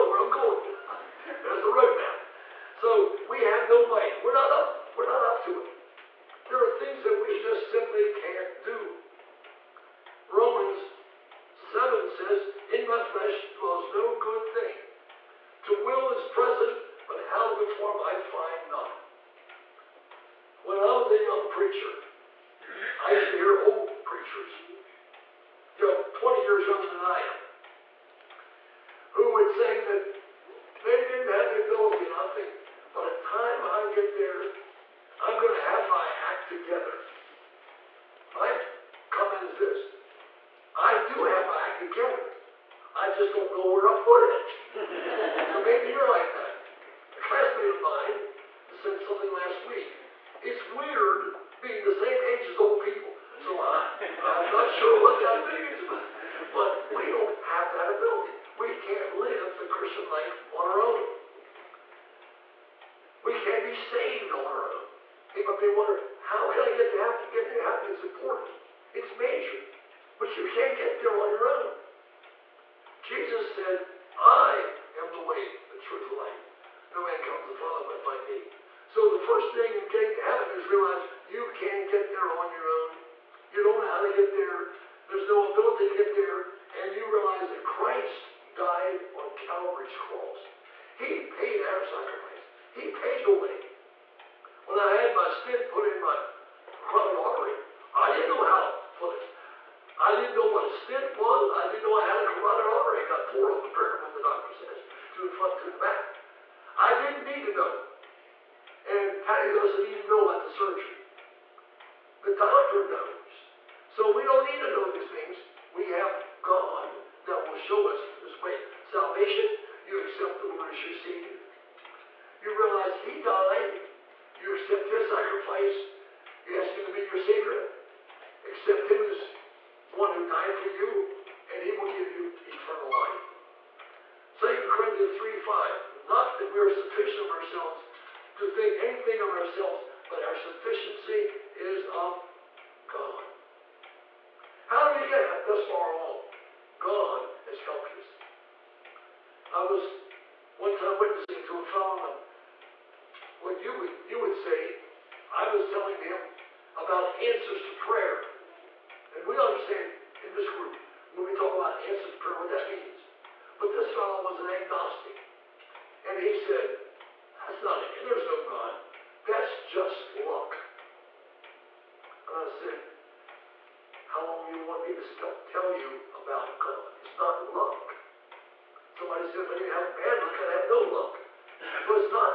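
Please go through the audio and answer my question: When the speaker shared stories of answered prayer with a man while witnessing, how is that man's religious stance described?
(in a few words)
agnostic.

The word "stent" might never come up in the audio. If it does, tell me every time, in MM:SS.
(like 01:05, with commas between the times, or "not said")
01:35, 01:40.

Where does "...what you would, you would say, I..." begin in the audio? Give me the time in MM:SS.
02:33.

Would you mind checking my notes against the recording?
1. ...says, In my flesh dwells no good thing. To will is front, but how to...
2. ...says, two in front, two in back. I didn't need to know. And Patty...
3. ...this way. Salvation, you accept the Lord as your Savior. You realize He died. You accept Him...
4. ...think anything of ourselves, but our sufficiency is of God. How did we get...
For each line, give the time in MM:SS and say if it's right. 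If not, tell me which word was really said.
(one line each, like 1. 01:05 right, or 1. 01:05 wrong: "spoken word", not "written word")
1. 00:12 wrong: "present", not "front"
2. 01:44 right
3. 01:58 wrong: "His", not "Him"
4. 02:18 right.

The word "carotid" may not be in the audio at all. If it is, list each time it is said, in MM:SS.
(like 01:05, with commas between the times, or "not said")
01:36, 01:42.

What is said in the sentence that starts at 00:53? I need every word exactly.
So I, I'm not sure what that means, but, but we don't have that ability.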